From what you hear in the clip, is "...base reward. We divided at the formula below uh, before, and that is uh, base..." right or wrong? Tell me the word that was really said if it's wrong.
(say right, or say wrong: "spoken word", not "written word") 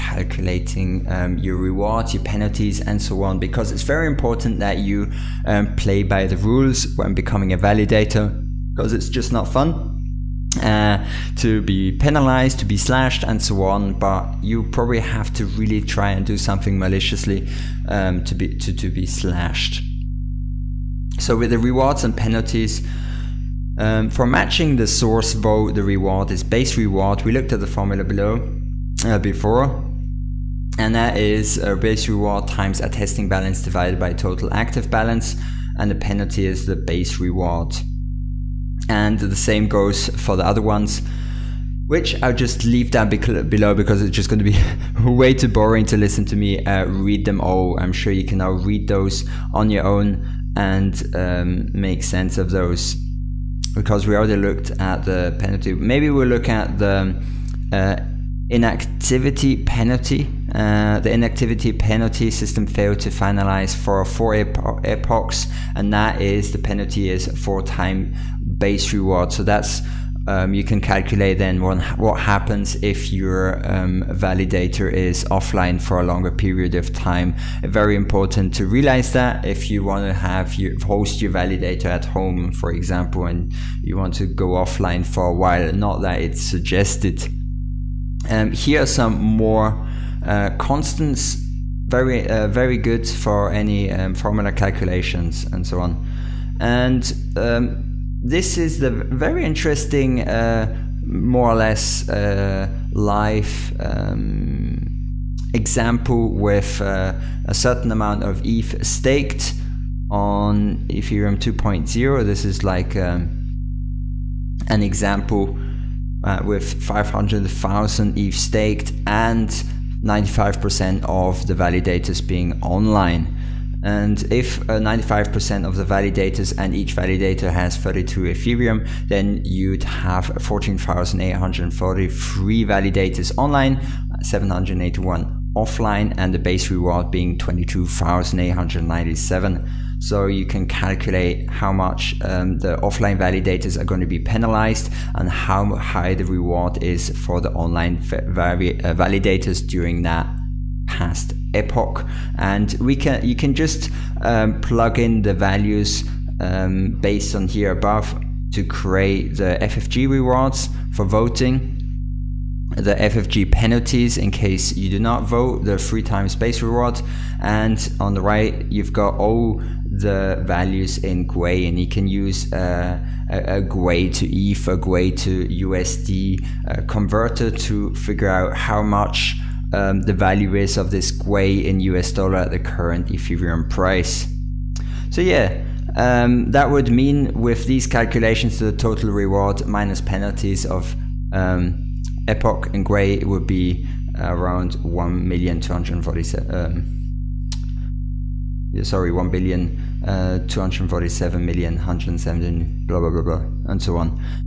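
wrong: "looked", not "divided".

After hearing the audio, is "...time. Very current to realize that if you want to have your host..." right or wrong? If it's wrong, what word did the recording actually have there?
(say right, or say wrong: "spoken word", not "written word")
wrong: "important", not "current".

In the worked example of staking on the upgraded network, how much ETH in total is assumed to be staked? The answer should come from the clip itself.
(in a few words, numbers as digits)
500,000 ETH.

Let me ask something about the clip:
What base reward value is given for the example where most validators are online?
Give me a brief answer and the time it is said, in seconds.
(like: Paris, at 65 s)
22,897, at 137 s.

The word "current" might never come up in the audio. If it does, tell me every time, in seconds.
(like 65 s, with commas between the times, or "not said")
182 s.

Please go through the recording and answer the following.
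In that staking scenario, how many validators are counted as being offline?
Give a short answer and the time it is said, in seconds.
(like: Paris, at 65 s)
781, at 134 s.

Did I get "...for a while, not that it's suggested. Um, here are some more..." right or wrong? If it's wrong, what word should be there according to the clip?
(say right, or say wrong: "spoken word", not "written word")
right.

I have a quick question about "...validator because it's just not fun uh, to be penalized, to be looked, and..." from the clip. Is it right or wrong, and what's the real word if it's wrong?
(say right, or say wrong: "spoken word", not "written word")
wrong: "slashed", not "looked".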